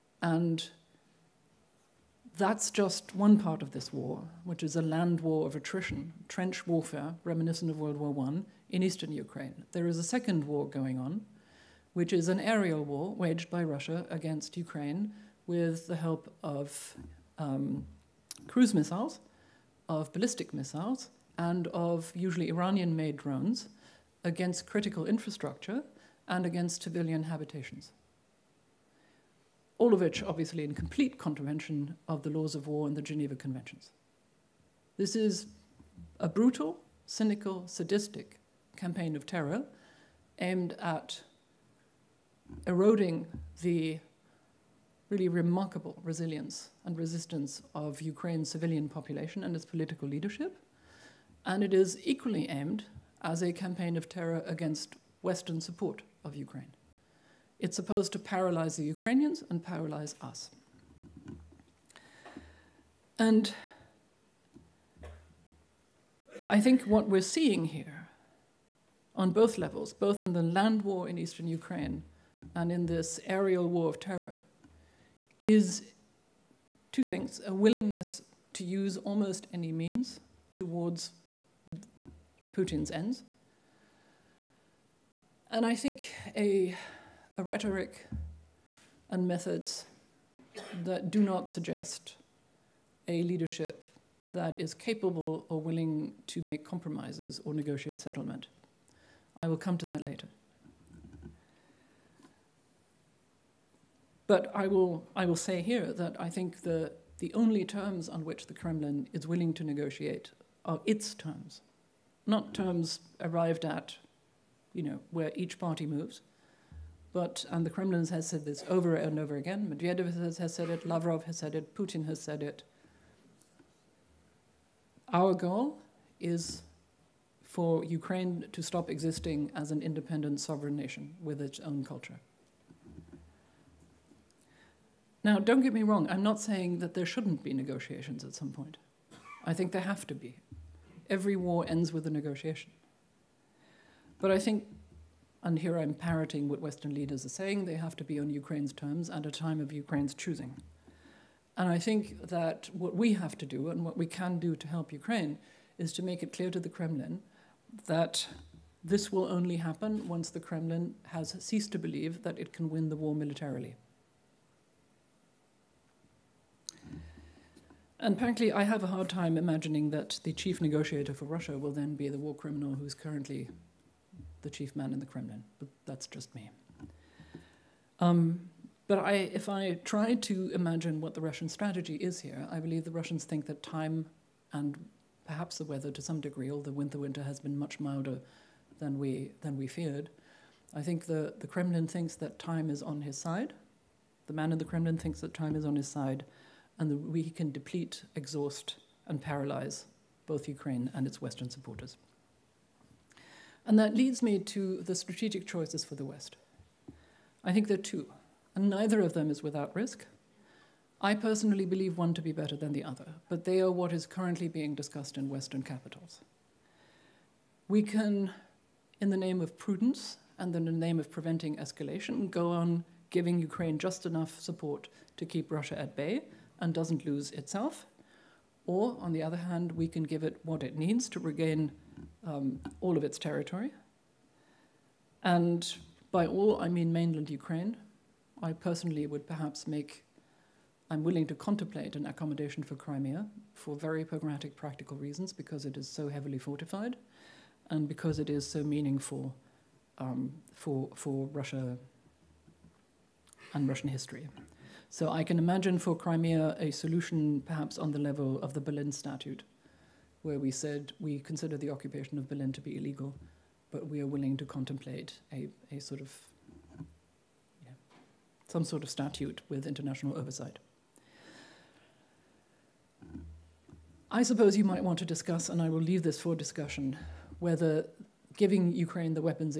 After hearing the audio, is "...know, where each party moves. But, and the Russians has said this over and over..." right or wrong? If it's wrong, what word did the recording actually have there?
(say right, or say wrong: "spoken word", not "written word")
wrong: "Kremlin", not "Russians".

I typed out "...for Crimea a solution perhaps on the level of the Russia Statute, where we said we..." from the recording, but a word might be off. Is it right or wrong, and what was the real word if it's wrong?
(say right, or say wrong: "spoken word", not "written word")
wrong: "Berlin", not "Russia".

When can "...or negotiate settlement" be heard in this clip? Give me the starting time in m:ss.
1:37.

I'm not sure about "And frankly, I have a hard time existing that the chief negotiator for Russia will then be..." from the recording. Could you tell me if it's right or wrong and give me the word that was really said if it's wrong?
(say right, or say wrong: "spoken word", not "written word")
wrong: "imagining", not "existing".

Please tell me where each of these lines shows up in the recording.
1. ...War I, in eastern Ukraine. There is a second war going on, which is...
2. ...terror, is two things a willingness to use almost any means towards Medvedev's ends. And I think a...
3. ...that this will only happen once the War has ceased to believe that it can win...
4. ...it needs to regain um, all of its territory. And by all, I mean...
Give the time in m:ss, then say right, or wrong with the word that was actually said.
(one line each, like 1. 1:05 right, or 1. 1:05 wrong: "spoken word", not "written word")
1. 0:07 right
2. 1:13 wrong: "Putin", not "Medvedev"
3. 2:37 wrong: "Kremlin", not "War"
4. 3:50 right.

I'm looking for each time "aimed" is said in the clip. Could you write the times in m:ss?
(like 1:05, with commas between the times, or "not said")
0:40, 0:52.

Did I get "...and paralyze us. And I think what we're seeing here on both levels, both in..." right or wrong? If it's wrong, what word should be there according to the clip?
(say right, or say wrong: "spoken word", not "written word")
right.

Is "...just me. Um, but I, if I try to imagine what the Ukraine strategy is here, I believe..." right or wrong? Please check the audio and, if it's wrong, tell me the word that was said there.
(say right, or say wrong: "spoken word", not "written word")
wrong: "Russian", not "Ukraine".